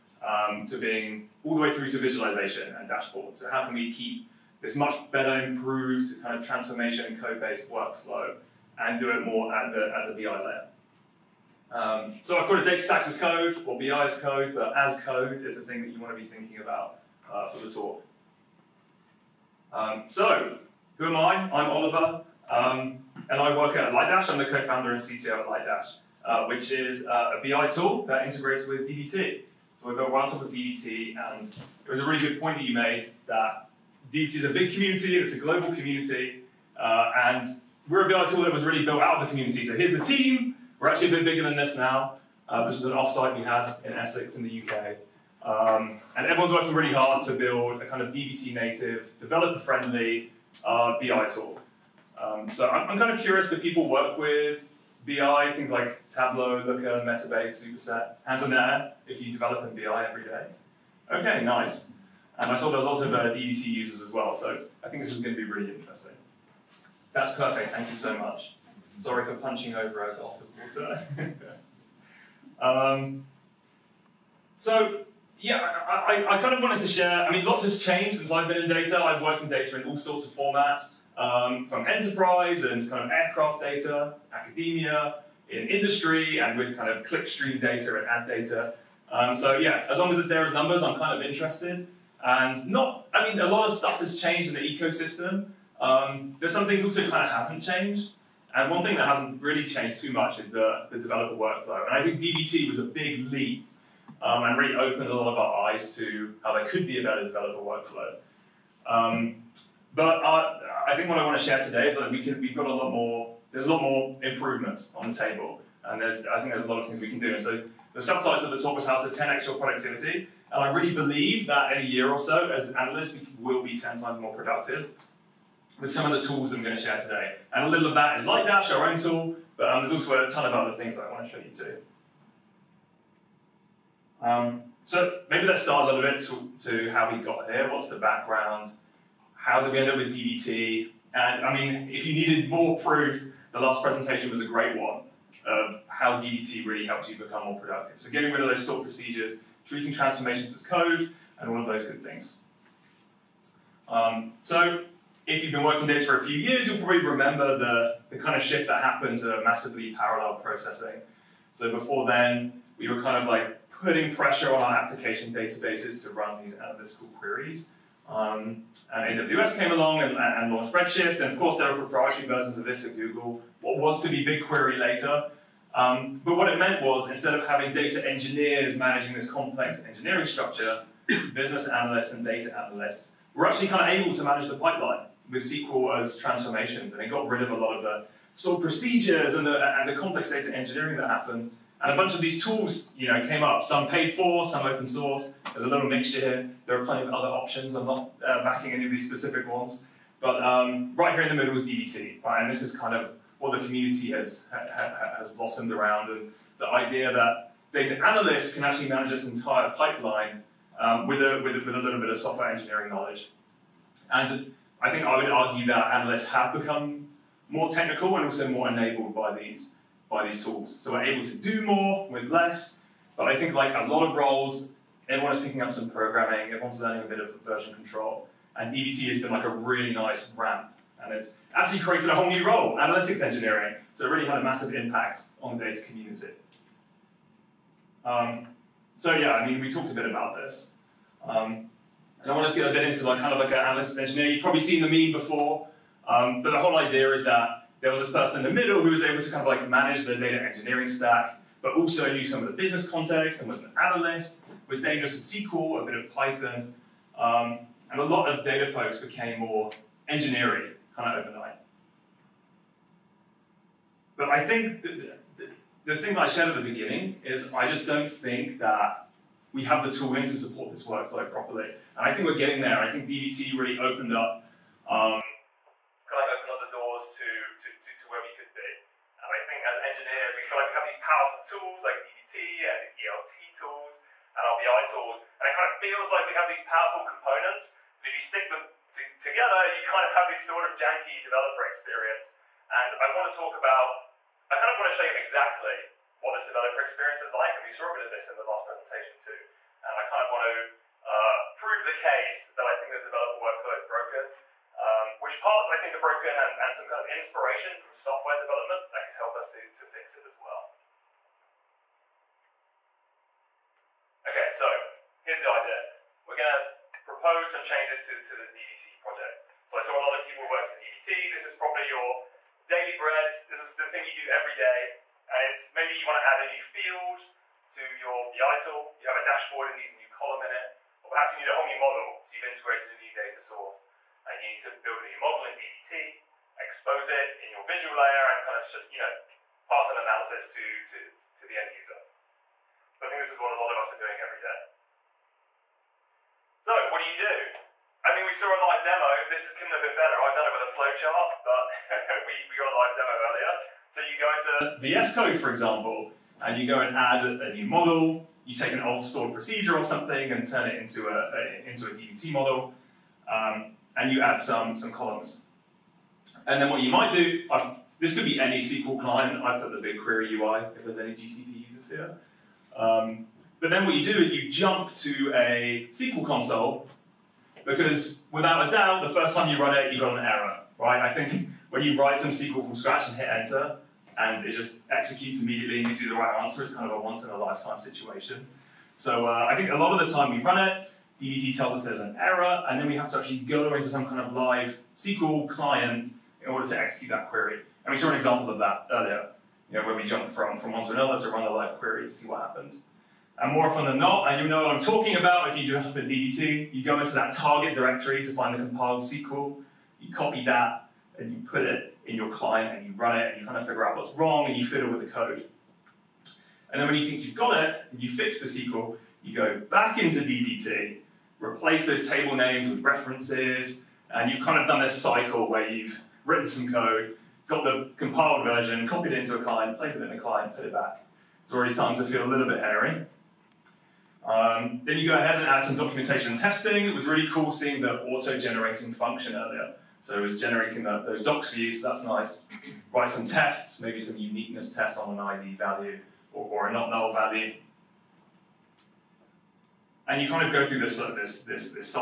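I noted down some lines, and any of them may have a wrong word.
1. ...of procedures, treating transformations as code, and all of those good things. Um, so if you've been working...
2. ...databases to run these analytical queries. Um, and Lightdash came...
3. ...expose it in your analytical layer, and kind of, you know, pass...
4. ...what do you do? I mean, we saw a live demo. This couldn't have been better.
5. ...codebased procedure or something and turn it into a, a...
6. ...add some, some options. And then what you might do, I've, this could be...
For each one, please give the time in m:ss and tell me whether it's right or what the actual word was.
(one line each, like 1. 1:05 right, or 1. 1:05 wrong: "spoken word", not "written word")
1. 2:28 right
2. 2:45 wrong: "AWS", not "Lightdash"
3. 5:36 wrong: "visual", not "analytical"
4. 5:46 right
5. 5:59 wrong: "stored", not "codebased"
6. 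6:04 wrong: "columns", not "options".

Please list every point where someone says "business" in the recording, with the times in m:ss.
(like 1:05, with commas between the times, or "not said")
3:01, 4:12.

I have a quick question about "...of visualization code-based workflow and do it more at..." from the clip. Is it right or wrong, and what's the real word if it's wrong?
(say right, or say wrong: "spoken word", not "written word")
wrong: "transformation", not "visualization".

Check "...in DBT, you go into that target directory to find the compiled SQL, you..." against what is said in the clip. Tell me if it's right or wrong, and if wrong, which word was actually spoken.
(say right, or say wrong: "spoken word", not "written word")
right.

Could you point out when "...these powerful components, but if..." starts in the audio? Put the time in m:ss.
4:46.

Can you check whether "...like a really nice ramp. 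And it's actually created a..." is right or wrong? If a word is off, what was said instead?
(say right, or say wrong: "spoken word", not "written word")
right.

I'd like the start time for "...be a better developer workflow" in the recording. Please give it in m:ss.
1:46.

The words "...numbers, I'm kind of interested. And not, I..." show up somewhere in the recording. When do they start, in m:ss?
1:30.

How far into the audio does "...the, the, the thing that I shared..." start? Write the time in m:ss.
4:24.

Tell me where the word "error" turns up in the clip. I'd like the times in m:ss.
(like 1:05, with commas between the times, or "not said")
6:20, 6:32.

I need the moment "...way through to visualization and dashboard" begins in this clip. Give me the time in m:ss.
0:01.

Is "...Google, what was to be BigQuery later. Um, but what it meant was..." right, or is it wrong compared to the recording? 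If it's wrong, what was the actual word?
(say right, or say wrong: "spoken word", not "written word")
right.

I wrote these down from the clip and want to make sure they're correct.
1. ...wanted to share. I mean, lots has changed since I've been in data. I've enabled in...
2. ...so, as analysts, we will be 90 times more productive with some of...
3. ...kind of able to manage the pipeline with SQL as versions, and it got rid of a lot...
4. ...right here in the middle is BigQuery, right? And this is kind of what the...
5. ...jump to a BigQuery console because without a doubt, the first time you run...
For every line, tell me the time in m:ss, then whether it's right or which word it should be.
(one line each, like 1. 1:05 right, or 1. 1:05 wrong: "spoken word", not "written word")
1. 1:16 wrong: "worked", not "enabled"
2. 2:02 wrong: "10", not "90"
3. 3:03 wrong: "transformations", not "versions"
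4. 3:20 wrong: "DBT", not "BigQuery"
5. 6:14 wrong: "SQL", not "BigQuery".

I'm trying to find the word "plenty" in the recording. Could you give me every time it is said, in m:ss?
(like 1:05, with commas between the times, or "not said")
3:16.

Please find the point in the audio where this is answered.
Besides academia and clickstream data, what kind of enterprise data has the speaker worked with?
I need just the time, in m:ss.
1:23.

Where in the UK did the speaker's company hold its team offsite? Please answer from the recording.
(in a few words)
Essex.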